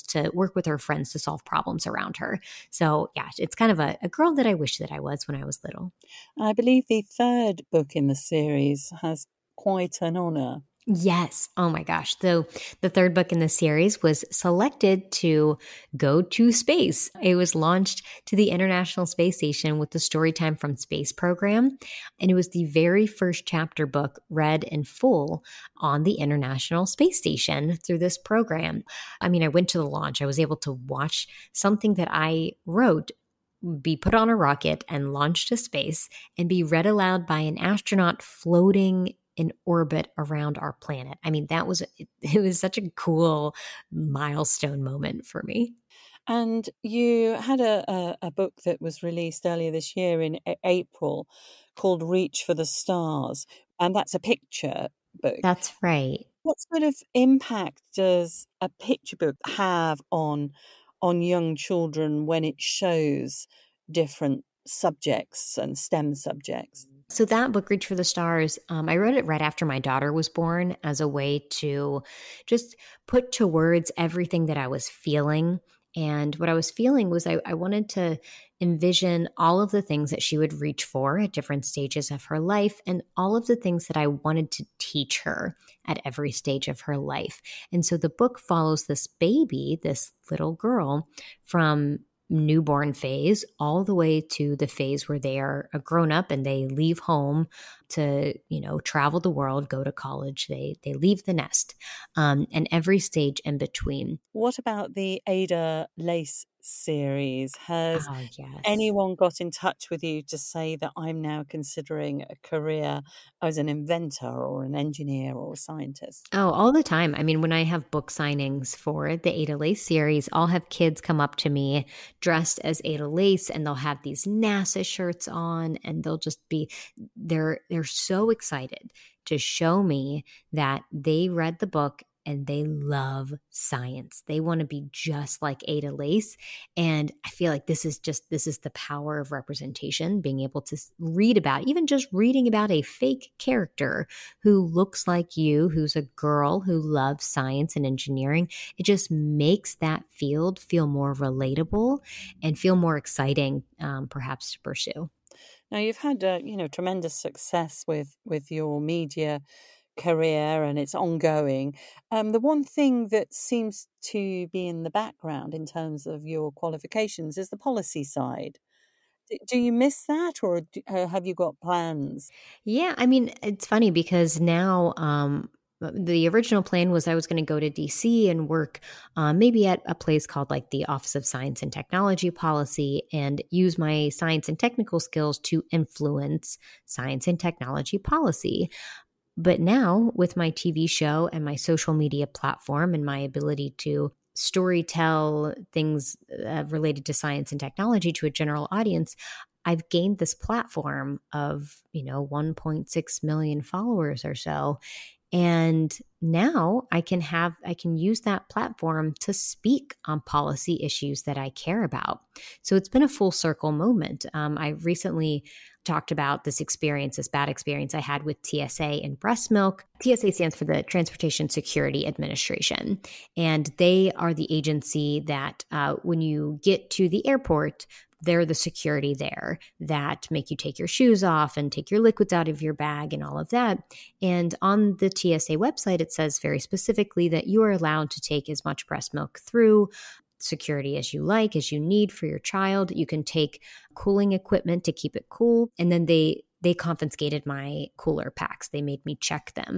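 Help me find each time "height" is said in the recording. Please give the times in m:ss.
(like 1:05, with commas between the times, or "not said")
not said.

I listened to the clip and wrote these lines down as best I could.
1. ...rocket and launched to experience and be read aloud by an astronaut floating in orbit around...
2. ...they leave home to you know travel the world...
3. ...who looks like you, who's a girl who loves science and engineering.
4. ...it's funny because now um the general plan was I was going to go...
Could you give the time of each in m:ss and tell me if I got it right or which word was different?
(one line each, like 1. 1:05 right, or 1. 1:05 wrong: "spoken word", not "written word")
1. 0:34 wrong: "space", not "experience"
2. 1:36 right
3. 2:24 right
4. 2:53 wrong: "original", not "general".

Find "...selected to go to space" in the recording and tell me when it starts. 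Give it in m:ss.
0:14.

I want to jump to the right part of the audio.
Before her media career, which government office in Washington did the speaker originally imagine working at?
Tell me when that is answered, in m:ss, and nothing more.
3:00.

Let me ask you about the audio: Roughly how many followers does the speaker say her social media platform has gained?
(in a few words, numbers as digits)
1.6 million.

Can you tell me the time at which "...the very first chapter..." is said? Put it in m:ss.
0:22.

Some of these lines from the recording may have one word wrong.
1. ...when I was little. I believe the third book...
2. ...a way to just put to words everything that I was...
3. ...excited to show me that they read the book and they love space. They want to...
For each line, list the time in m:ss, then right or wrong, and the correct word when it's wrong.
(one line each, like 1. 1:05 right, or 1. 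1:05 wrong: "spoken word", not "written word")
1. 0:05 right
2. 1:10 right
3. 2:08 wrong: "science", not "space".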